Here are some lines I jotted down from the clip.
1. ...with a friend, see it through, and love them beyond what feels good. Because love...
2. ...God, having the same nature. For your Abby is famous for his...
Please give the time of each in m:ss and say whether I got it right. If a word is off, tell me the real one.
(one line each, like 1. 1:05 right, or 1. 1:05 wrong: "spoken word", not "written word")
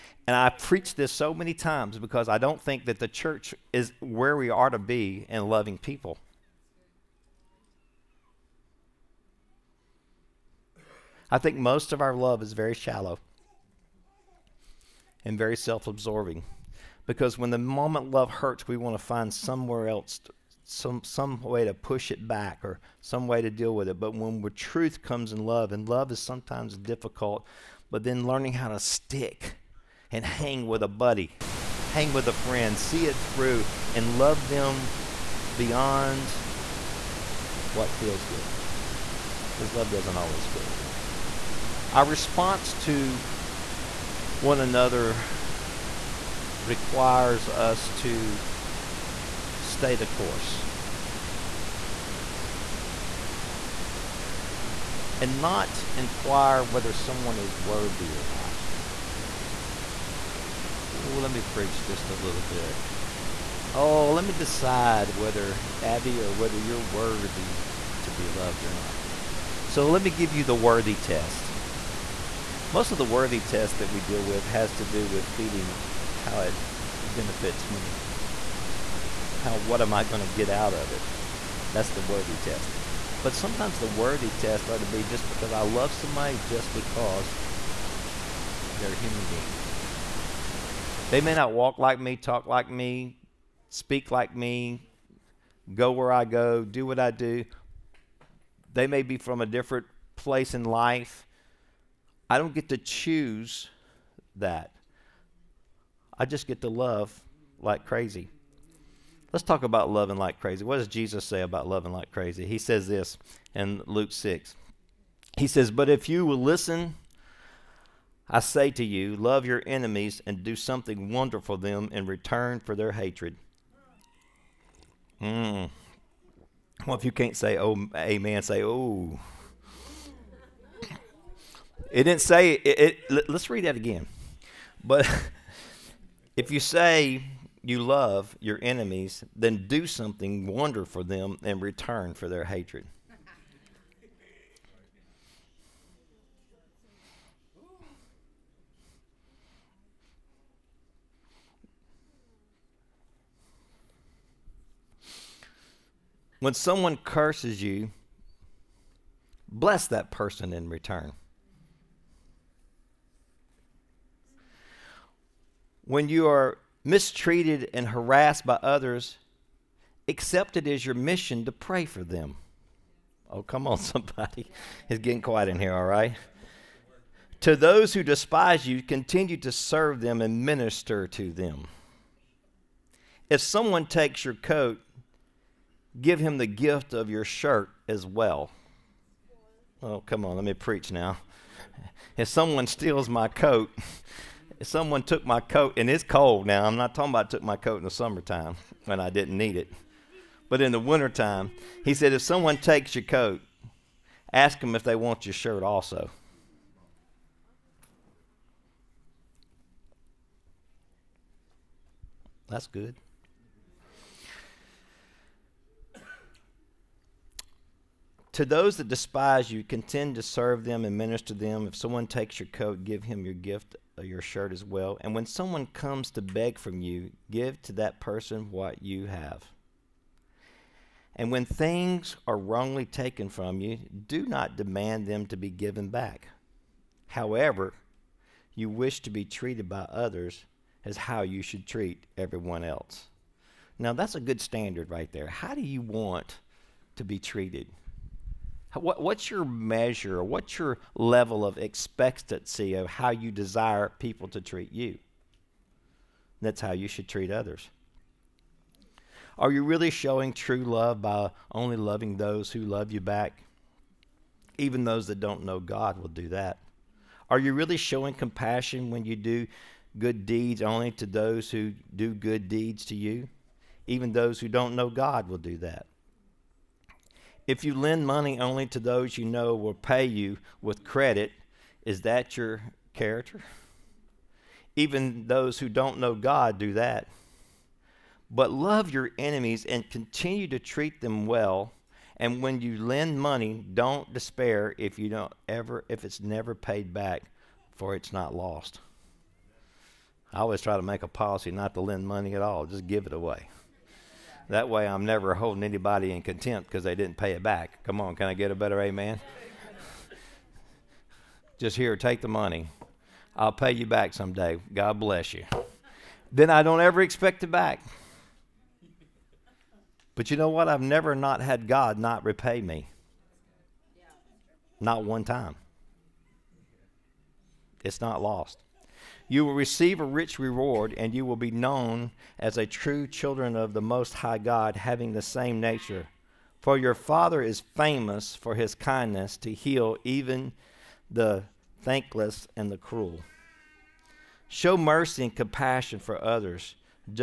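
1. 0:32 right
2. 5:34 wrong: "Father", not "Abby".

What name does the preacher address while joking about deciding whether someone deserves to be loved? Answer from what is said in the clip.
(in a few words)
Abby.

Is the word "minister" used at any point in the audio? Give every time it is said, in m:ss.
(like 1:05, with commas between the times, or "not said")
3:00, 3:40.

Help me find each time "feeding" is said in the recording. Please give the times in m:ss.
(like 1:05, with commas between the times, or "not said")
1:15.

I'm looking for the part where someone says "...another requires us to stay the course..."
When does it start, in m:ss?
0:44.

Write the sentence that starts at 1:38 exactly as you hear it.
They may be from a different place in life.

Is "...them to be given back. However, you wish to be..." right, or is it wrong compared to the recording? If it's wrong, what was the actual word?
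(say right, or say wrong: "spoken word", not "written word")
right.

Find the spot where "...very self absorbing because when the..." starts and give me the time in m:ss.
0:15.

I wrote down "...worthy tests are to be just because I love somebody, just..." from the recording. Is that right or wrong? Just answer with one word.
right.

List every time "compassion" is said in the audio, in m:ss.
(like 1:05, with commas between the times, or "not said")
4:28, 5:45.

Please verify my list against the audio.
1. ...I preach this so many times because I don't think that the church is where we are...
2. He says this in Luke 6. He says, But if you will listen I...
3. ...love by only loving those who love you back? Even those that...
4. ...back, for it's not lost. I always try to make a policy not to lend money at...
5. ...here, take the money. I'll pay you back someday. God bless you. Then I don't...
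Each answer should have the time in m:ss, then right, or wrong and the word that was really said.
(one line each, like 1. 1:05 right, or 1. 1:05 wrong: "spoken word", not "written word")
1. 0:00 right
2. 1:52 right
3. 4:20 right
4. 4:56 right
5. 5:11 right.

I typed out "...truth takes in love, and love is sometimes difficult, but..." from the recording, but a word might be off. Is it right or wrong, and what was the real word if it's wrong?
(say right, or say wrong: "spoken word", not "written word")
wrong: "comes", not "takes".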